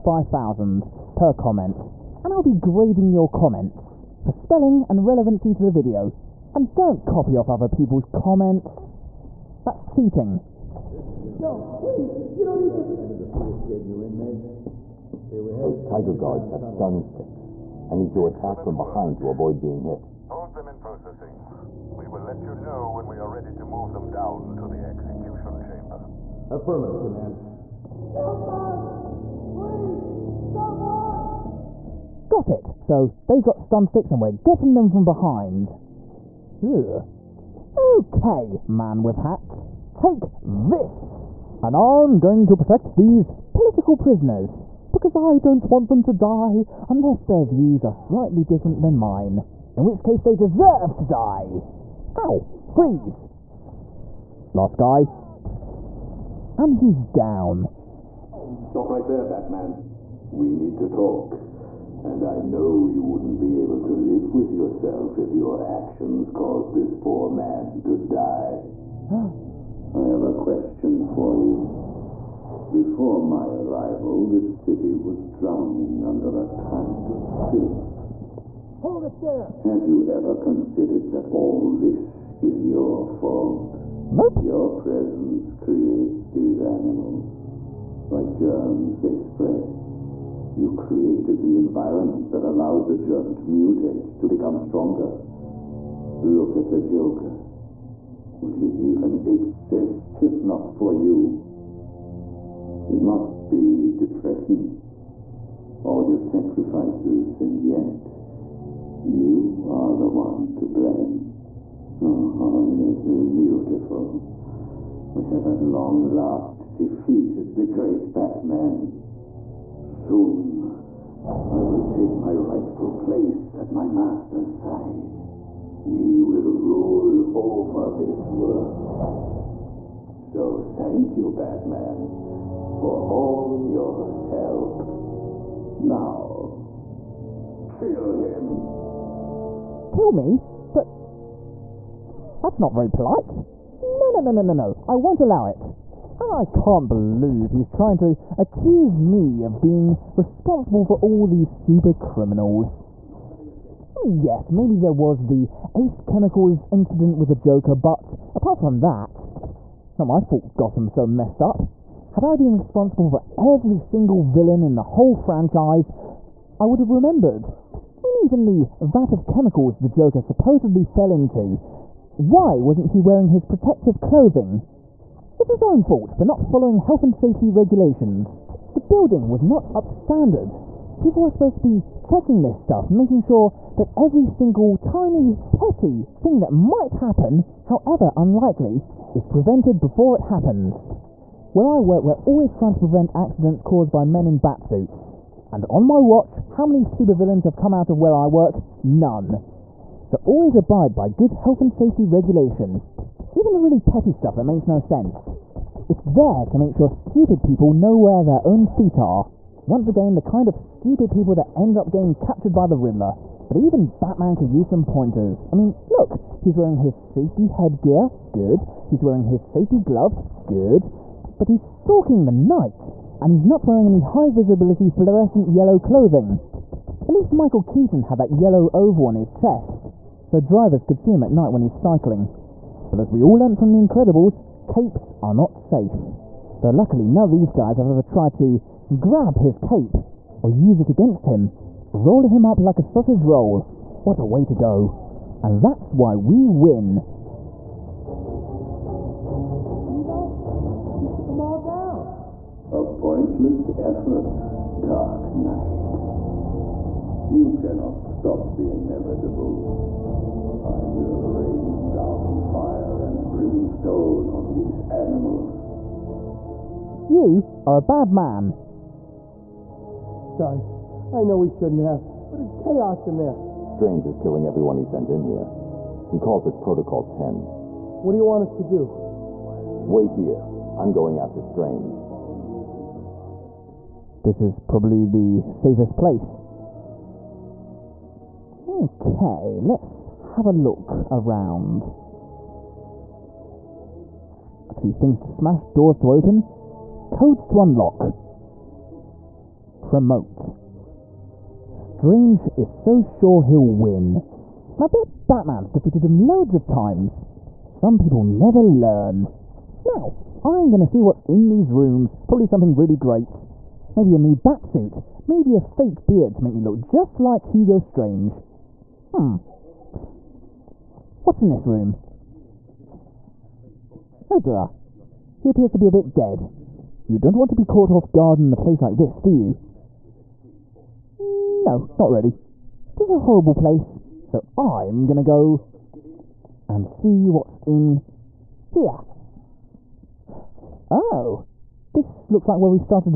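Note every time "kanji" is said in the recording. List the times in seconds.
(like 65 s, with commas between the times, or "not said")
not said.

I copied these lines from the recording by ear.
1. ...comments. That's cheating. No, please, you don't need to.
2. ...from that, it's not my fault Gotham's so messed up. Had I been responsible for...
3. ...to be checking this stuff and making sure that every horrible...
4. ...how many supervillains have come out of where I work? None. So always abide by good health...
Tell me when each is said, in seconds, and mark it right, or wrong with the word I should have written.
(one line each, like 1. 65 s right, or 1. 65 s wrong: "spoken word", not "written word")
1. 8 s right
2. 158 s right
3. 181 s wrong: "single", not "horrible"
4. 196 s right.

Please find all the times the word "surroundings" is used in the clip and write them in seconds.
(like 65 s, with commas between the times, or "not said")
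not said.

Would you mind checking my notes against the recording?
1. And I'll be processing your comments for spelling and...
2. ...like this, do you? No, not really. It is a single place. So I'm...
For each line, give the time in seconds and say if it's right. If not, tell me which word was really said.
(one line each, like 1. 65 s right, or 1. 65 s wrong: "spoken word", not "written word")
1. 2 s wrong: "grading", not "processing"
2. 328 s wrong: "horrible", not "single".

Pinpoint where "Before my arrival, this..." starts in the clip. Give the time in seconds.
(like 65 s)
72 s.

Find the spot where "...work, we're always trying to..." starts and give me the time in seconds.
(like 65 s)
191 s.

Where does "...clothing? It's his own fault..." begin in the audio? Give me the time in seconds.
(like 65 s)
173 s.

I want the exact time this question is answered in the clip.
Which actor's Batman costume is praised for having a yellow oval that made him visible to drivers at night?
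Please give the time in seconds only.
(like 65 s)
227 s.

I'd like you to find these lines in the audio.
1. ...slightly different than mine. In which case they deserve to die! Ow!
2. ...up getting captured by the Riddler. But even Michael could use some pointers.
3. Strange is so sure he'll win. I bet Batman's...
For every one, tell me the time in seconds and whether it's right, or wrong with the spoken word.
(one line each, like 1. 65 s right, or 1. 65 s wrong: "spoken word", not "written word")
1. 47 s right
2. 211 s wrong: "Batman", not "Michael"
3. 301 s right.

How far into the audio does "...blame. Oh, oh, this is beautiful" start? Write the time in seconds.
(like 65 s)
110 s.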